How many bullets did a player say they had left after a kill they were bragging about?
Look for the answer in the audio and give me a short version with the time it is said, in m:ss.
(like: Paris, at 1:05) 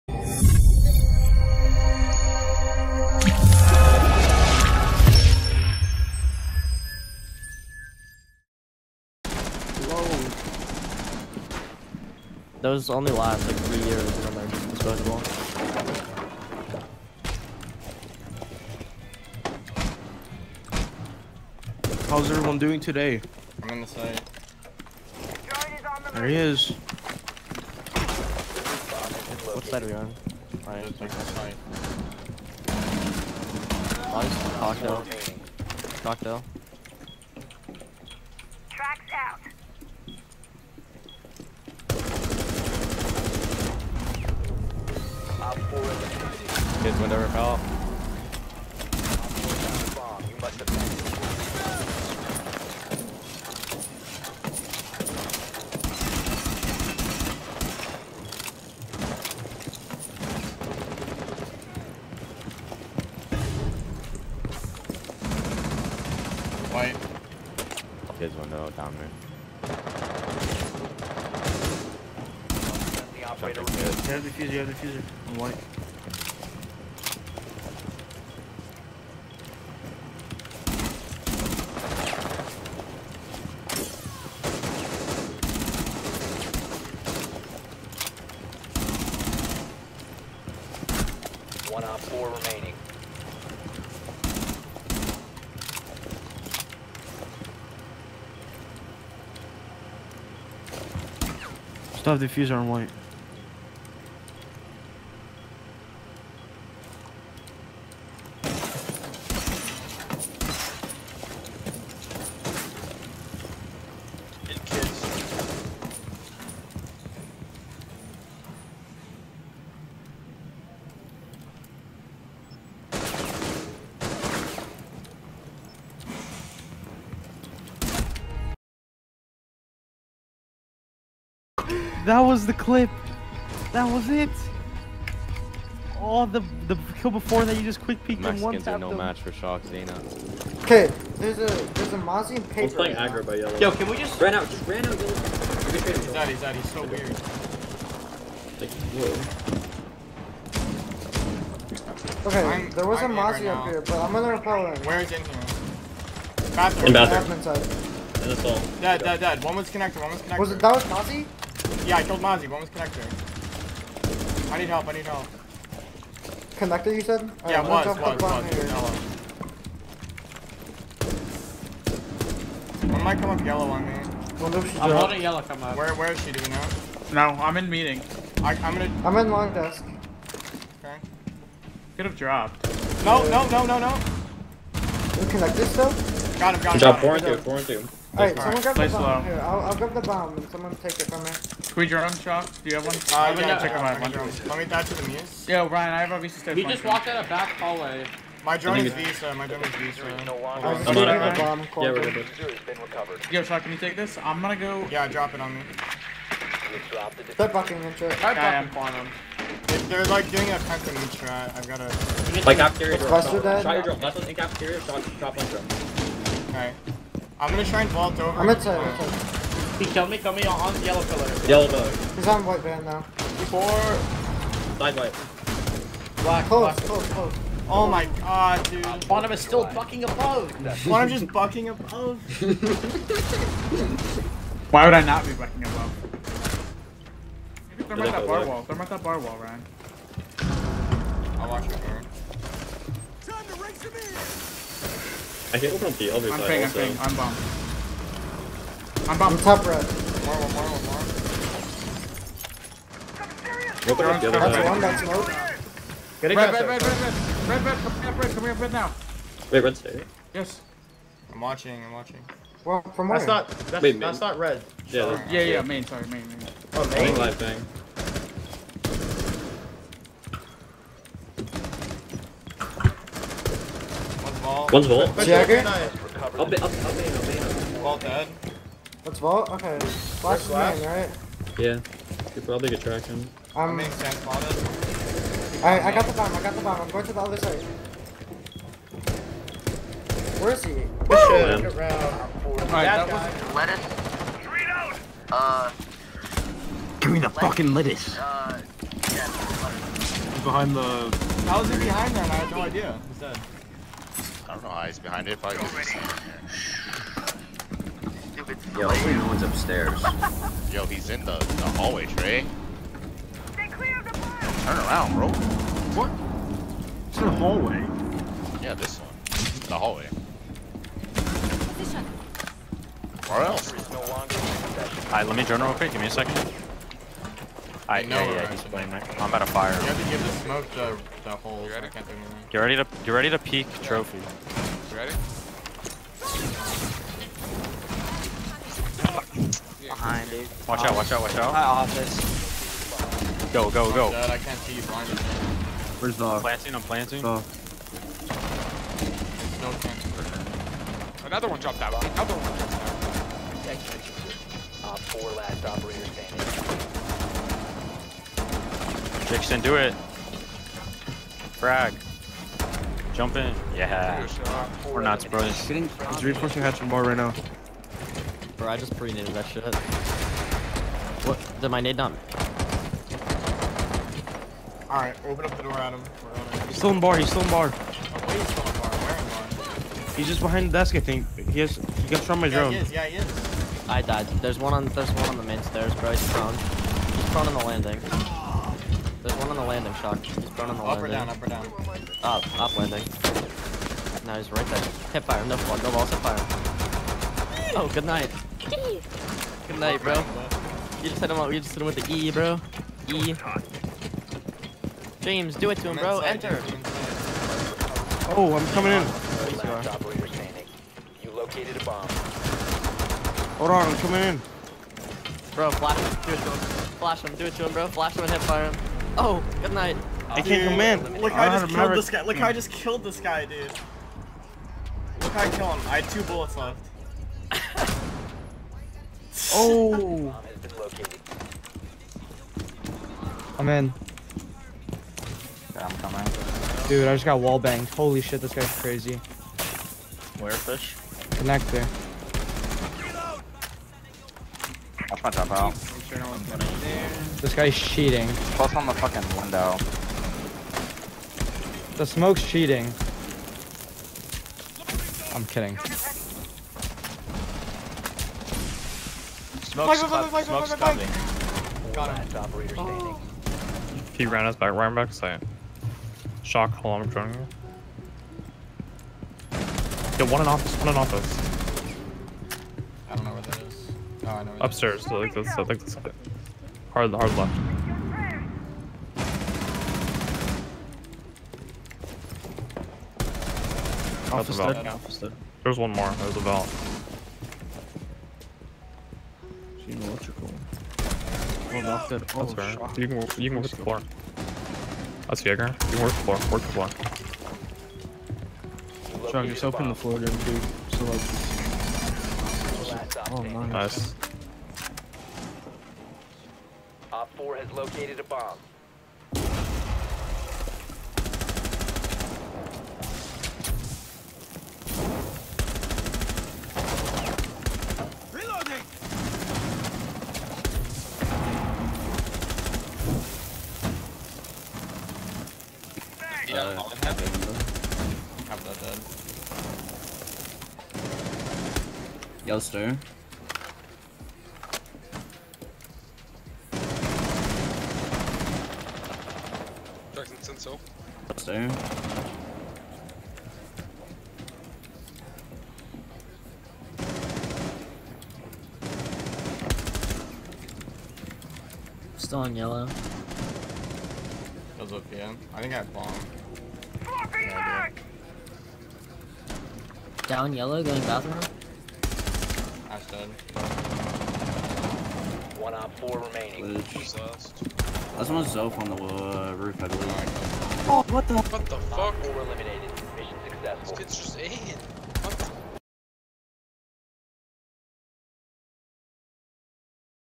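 2, at 7:06.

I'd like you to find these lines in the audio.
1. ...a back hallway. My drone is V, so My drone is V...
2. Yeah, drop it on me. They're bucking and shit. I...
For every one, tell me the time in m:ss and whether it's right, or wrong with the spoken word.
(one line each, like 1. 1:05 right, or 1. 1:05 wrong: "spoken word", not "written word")
1. 3:17 right
2. 3:24 right.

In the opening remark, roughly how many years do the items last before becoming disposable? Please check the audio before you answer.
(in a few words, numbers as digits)
3.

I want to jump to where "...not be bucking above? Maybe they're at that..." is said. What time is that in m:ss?
3:55.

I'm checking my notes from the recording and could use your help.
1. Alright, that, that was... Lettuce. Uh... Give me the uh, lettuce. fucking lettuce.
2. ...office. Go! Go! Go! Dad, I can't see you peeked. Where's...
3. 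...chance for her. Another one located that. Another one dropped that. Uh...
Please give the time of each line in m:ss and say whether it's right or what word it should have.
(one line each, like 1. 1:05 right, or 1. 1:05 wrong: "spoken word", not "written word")
1. 4:52 right
2. 5:41 wrong: "blinded", not "peeked"
3. 5:49 wrong: "dropped", not "located".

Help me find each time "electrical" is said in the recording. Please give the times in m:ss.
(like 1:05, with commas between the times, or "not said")
8:09.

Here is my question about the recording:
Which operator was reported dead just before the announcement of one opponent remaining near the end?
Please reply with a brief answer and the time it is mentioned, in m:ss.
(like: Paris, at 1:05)
Ash, at 9:22.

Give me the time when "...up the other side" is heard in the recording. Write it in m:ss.
4:14.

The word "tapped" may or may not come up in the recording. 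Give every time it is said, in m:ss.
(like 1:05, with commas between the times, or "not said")
2:18.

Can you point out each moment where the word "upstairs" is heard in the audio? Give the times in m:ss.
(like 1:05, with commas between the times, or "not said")
5:09, 7:54.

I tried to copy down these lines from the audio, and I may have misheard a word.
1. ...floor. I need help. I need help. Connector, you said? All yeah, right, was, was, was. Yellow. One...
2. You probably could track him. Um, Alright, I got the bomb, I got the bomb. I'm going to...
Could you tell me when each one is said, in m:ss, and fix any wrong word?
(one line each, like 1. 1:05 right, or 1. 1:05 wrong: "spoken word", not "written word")
1. 2:42 wrong: "connector", not "floor"
2. 4:42 right.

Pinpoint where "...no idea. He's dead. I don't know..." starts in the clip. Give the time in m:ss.
5:02.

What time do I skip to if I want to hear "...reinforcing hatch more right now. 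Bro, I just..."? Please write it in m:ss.
6:05.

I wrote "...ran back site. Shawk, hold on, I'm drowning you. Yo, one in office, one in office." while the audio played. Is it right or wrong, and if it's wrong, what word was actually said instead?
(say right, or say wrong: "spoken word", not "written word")
right.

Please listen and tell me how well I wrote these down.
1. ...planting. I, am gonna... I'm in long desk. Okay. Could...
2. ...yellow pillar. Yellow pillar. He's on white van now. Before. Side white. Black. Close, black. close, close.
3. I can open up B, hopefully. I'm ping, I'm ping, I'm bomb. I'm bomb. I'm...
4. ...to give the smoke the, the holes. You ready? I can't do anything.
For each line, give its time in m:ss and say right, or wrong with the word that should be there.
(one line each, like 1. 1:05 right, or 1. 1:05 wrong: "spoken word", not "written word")
1. 2:57 wrong: "meeting", not "planting"
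2. 3:40 right
3. 4:05 wrong: "obviously", not "hopefully"
4. 5:30 right.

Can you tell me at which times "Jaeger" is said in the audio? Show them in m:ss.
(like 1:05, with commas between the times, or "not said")
4:35, 8:15.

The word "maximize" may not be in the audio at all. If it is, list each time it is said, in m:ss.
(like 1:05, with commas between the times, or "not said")
not said.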